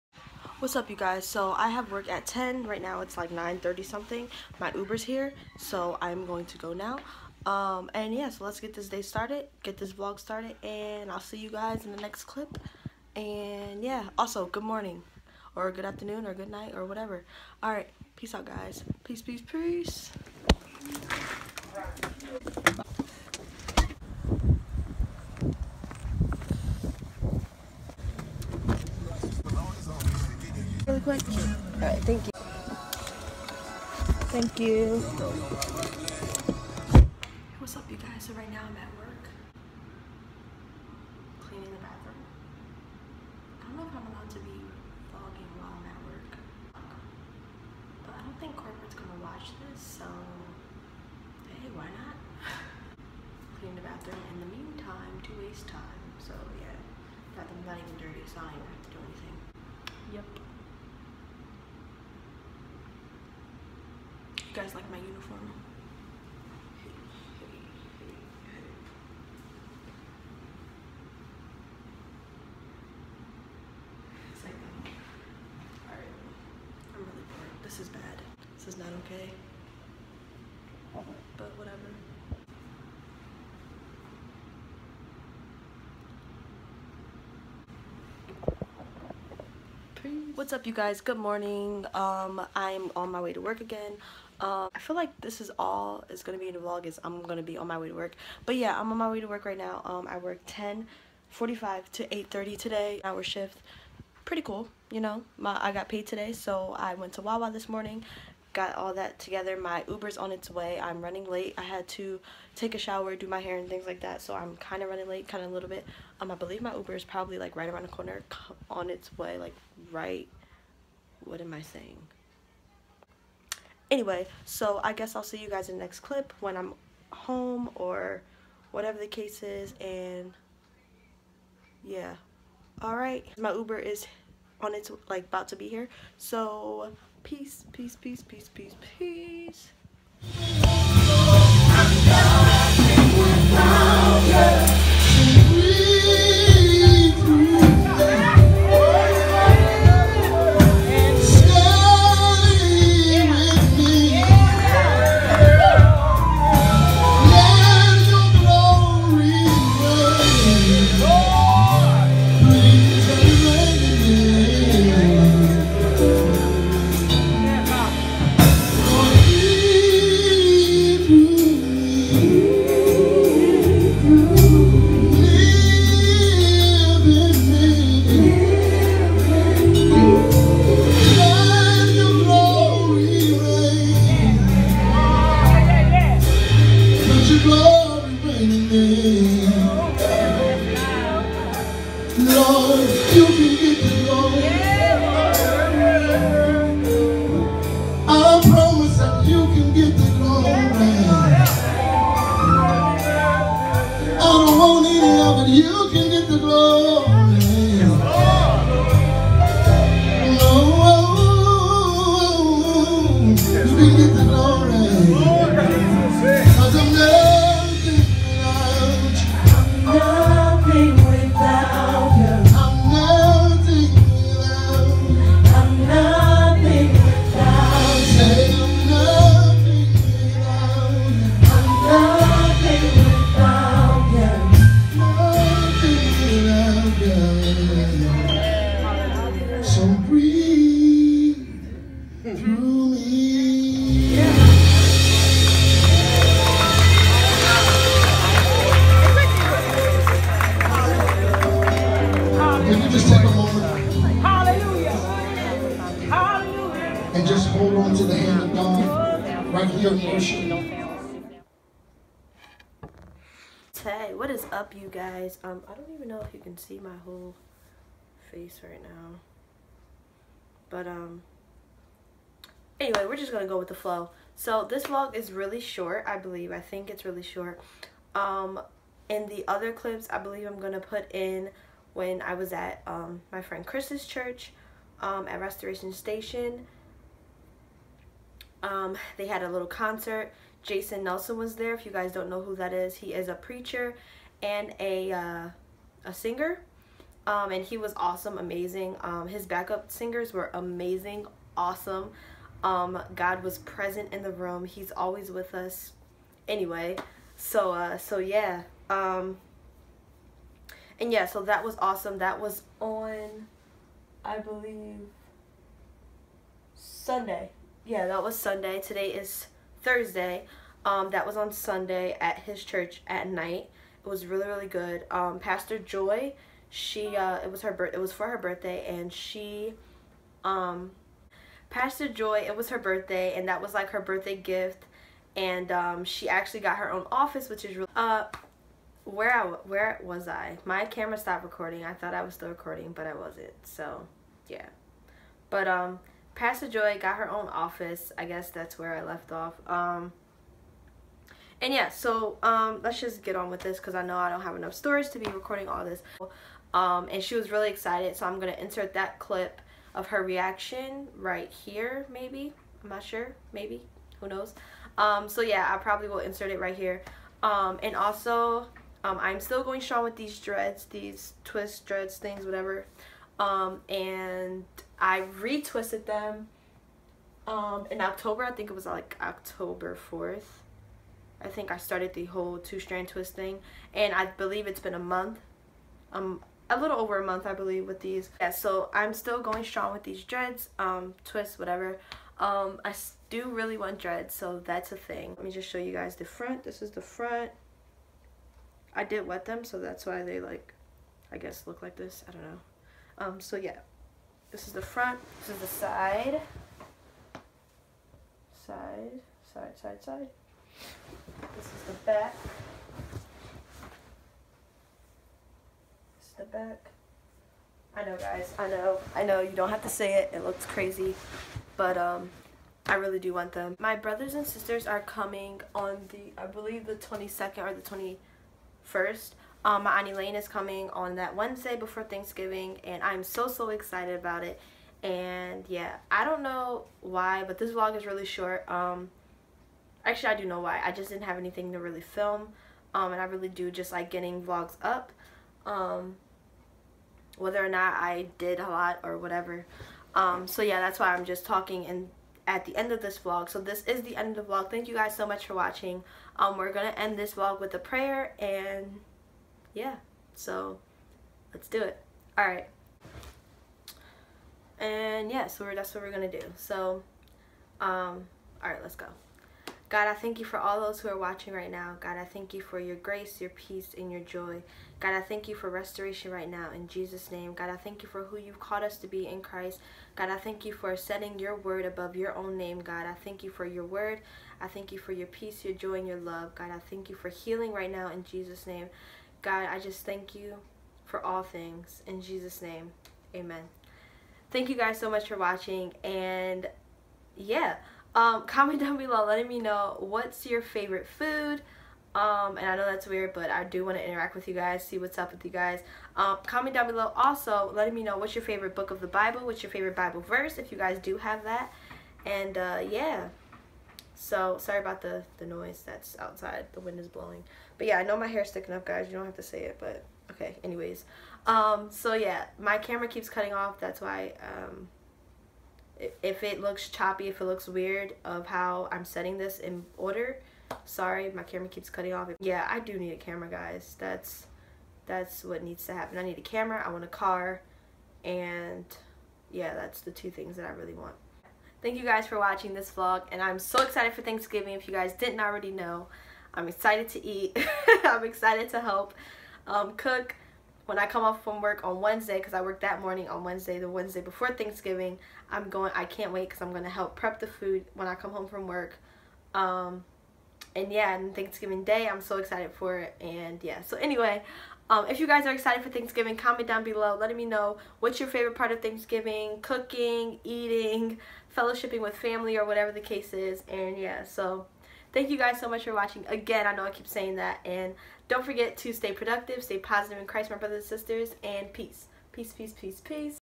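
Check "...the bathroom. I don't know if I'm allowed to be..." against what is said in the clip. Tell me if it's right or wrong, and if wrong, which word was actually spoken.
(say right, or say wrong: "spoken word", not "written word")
right.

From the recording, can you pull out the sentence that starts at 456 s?
Um, we're going to end this vlog with a prayer and yeah, so let's do it.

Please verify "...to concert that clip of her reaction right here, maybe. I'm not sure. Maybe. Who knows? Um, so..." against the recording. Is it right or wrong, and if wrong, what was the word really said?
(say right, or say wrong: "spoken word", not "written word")
wrong: "insert", not "concert".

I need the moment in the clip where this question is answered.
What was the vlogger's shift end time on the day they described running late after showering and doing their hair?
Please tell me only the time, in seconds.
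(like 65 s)
102 s.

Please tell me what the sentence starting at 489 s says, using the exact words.
God, I just thank you for all things.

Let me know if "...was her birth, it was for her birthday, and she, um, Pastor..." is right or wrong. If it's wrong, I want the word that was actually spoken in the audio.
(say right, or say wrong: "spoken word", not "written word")
right.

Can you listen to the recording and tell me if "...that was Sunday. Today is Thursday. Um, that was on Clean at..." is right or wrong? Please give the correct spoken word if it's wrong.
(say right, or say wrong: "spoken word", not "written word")
wrong: "Sunday", not "Clean".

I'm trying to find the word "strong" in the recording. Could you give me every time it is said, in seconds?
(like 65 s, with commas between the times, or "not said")
369 s, 389 s.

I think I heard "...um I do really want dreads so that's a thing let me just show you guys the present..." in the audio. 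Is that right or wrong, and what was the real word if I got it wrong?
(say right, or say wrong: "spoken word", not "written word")
wrong: "front", not "present".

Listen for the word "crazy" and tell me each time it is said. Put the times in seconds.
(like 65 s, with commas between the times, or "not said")
420 s.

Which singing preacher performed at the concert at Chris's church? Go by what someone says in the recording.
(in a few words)
Jason Nelson.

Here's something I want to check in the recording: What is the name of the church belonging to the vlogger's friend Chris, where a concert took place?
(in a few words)
Restoration Station.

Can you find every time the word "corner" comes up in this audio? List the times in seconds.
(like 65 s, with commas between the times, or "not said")
117 s.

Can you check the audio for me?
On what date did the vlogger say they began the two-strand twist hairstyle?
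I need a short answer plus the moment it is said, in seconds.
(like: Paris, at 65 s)
October 4th, at 379 s.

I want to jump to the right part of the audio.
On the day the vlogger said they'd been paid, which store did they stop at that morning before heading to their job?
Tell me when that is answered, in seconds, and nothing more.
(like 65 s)
107 s.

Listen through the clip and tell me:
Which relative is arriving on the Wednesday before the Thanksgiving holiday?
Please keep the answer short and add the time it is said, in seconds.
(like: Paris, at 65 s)
Auntie Lane, at 429 s.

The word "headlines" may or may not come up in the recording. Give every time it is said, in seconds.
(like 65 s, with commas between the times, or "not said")
not said.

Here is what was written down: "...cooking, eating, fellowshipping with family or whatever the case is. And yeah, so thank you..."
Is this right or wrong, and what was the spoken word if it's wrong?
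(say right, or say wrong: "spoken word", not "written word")
right.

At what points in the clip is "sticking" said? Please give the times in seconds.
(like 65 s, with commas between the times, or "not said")
518 s.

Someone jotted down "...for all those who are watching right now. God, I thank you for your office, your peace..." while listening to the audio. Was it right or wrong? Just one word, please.
wrong.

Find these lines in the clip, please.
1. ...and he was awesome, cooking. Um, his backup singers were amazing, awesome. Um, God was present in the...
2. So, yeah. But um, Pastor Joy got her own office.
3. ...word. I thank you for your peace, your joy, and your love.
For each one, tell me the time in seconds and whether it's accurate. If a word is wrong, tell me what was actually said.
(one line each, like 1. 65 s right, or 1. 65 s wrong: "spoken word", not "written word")
1. 297 s wrong: "amazing", not "cooking"
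2. 343 s right
3. 483 s right.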